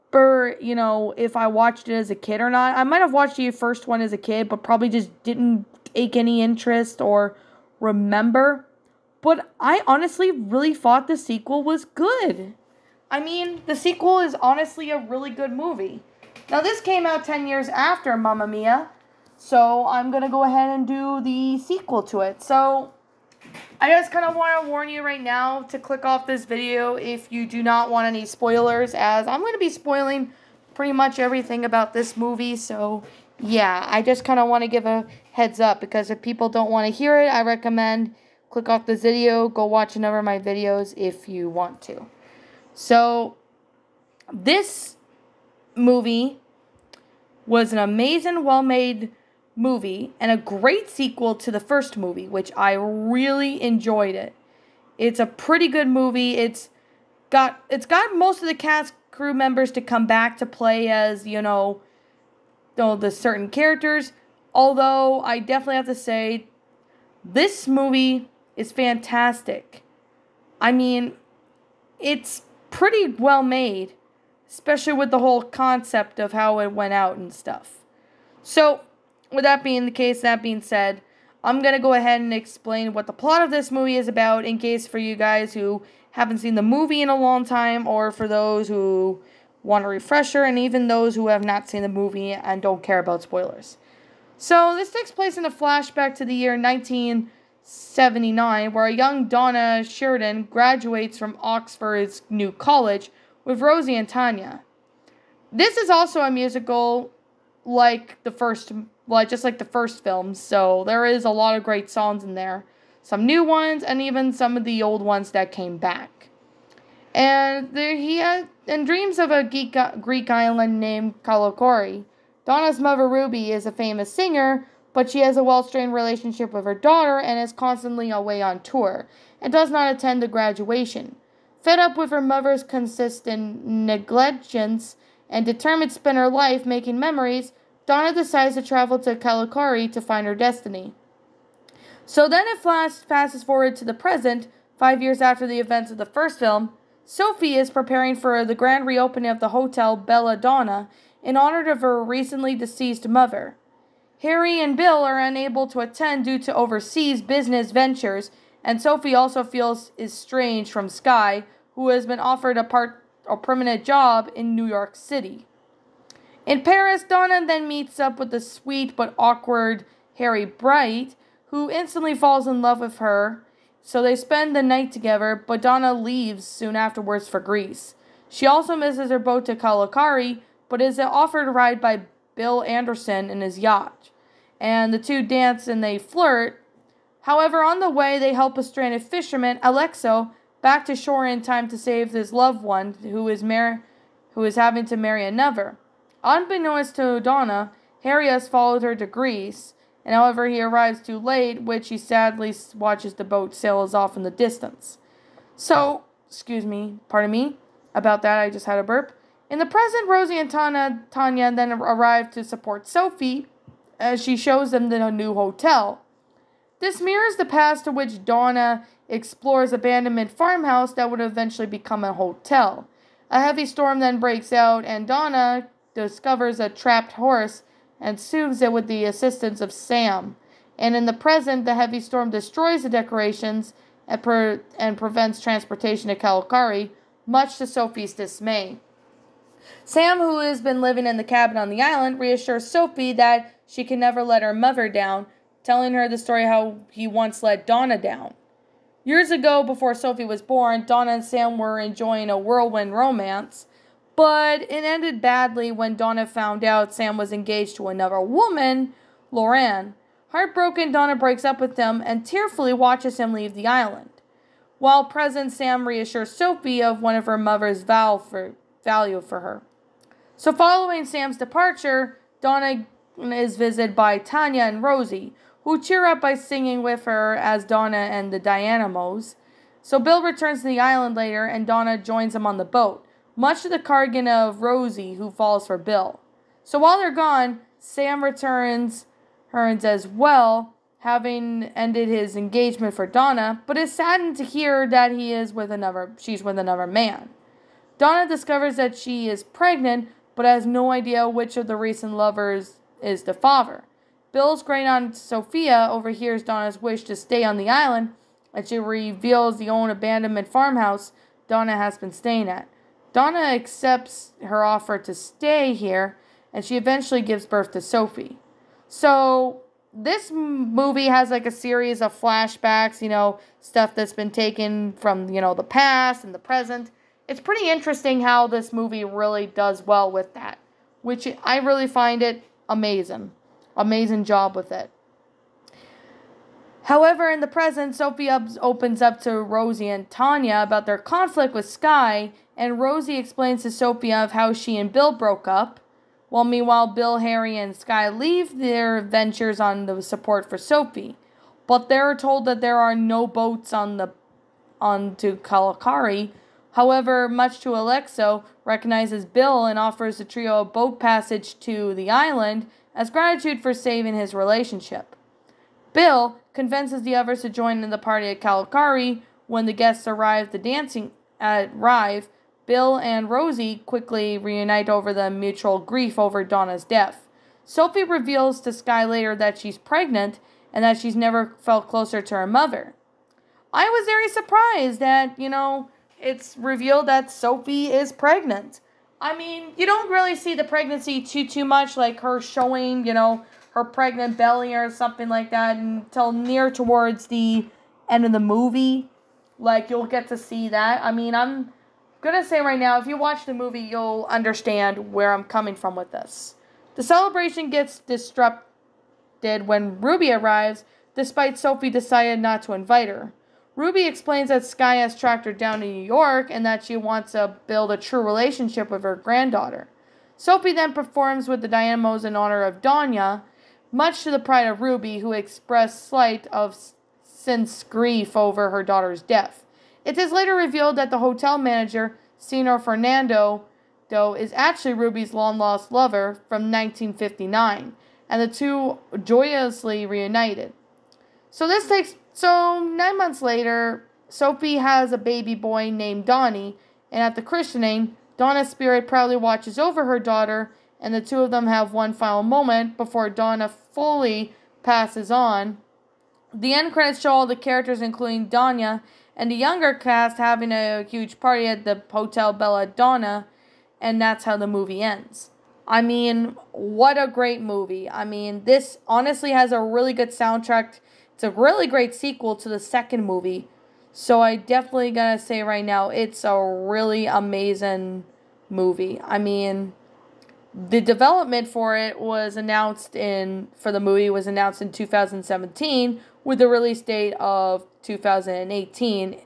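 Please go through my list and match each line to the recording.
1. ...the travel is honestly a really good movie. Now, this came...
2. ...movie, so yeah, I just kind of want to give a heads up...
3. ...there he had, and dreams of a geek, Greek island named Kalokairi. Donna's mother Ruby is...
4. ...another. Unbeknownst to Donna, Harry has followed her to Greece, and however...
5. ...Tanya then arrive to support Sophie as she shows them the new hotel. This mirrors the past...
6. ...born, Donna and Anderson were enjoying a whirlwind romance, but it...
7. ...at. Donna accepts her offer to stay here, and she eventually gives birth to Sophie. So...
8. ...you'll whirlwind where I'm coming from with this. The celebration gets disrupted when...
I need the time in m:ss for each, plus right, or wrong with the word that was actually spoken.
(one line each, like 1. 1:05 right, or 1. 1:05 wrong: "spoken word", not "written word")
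1. 0:13 wrong: "sequel", not "travel"
2. 0:32 right
3. 1:57 right
4. 3:15 right
5. 3:31 right
6. 4:10 wrong: "Sam", not "Anderson"
7. 5:12 right
8. 6:43 wrong: "understand", not "whirlwind".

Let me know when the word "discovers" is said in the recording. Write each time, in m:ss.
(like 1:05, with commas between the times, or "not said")
3:45, 4:58.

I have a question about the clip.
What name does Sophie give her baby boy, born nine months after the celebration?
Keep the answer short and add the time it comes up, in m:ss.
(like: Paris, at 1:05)
Donnie, at 7:26.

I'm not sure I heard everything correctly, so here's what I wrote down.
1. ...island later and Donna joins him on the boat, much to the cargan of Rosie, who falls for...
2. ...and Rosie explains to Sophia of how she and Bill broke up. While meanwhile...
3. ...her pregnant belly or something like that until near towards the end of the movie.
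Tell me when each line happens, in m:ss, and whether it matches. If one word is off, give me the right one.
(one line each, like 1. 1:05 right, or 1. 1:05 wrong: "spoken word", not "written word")
1. 4:40 right
2. 5:42 right
3. 6:33 right.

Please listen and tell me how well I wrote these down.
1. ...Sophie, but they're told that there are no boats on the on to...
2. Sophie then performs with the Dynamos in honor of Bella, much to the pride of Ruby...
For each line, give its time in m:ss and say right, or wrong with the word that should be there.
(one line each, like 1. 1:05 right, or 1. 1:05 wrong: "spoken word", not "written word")
1. 5:50 right
2. 7:00 wrong: "Danya", not "Bella".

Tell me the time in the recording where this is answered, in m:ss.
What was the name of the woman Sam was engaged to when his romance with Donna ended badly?
4:19.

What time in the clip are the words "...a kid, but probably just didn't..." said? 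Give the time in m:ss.
0:04.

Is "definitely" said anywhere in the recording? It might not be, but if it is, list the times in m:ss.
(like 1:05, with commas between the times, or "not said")
1:05, 7:54.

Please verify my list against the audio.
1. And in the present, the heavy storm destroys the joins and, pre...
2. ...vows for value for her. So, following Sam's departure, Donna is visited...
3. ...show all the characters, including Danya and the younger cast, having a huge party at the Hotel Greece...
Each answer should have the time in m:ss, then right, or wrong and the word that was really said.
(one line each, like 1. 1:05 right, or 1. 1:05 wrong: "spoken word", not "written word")
1. 3:50 wrong: "decorations", not "joins"
2. 4:27 right
3. 7:37 wrong: "Bella", not "Greece".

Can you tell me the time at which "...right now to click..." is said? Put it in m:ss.
0:25.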